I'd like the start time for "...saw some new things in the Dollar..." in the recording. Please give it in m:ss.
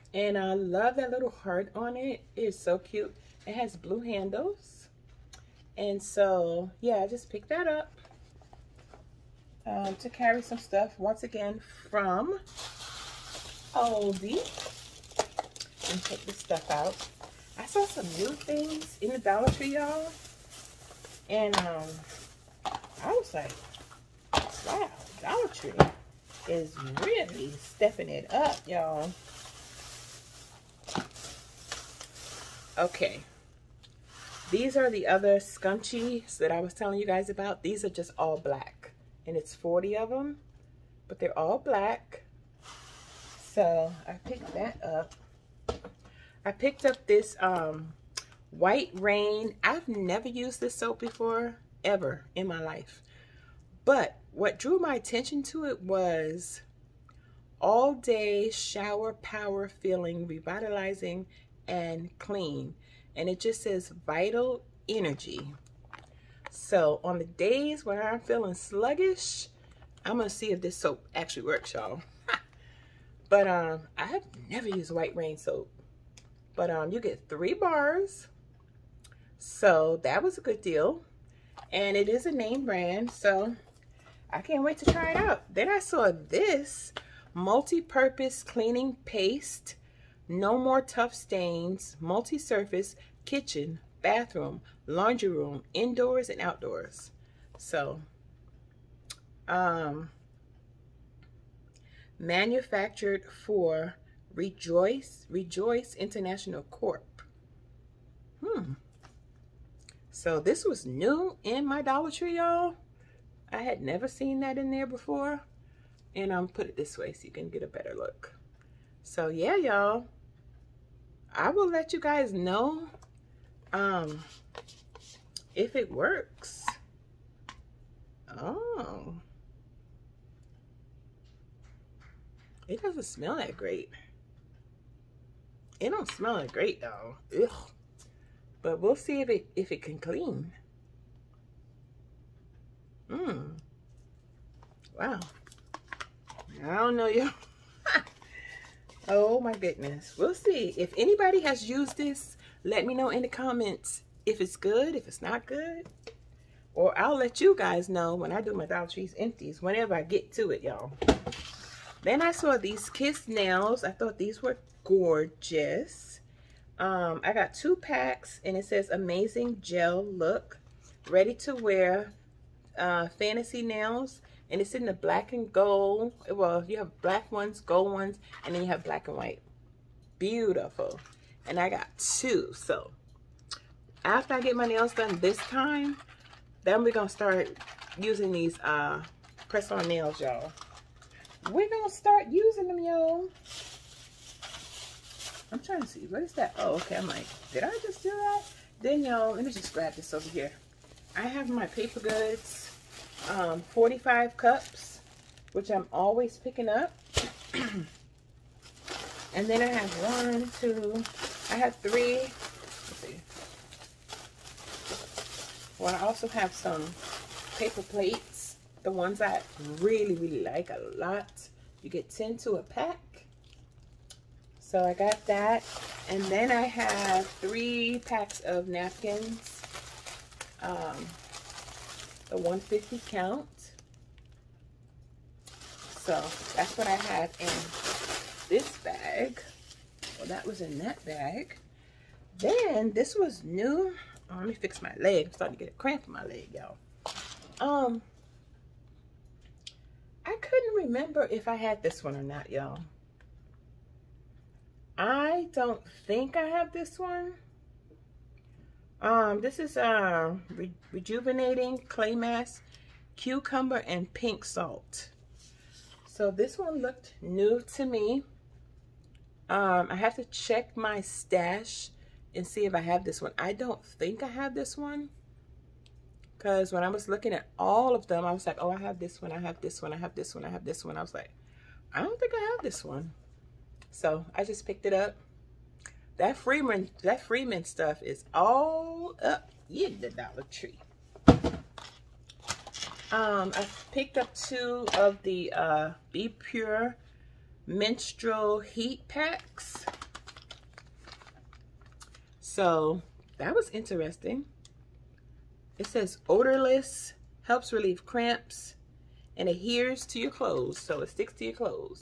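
0:17.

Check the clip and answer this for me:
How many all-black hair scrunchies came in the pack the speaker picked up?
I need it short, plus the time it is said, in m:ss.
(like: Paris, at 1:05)
40, at 0:39.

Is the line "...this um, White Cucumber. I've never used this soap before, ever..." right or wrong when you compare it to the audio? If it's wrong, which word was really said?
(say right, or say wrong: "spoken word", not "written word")
wrong: "Rain", not "Cucumber".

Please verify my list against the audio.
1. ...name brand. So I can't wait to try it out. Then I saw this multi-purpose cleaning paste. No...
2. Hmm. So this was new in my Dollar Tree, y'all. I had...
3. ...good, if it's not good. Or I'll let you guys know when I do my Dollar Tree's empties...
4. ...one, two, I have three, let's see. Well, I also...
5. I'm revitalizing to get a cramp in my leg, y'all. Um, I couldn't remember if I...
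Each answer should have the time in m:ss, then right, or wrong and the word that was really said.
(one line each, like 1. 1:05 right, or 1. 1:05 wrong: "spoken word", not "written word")
1. 1:22 right
2. 1:48 right
3. 2:34 right
4. 3:30 right
5. 4:05 wrong: "starting", not "revitalizing".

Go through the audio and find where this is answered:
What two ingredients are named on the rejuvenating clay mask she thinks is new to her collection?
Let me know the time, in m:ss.
4:23.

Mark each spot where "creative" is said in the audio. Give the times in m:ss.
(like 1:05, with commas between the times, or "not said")
not said.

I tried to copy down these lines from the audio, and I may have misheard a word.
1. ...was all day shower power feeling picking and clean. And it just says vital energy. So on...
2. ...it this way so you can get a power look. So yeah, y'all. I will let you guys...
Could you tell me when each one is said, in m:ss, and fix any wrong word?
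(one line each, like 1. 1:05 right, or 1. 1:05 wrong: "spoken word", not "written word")
1. 0:55 wrong: "revitalizing", not "picking"
2. 1:56 wrong: "better", not "power".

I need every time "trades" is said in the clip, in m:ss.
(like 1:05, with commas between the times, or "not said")
not said.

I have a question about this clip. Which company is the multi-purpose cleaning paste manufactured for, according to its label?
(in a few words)
Rejoice International Corp.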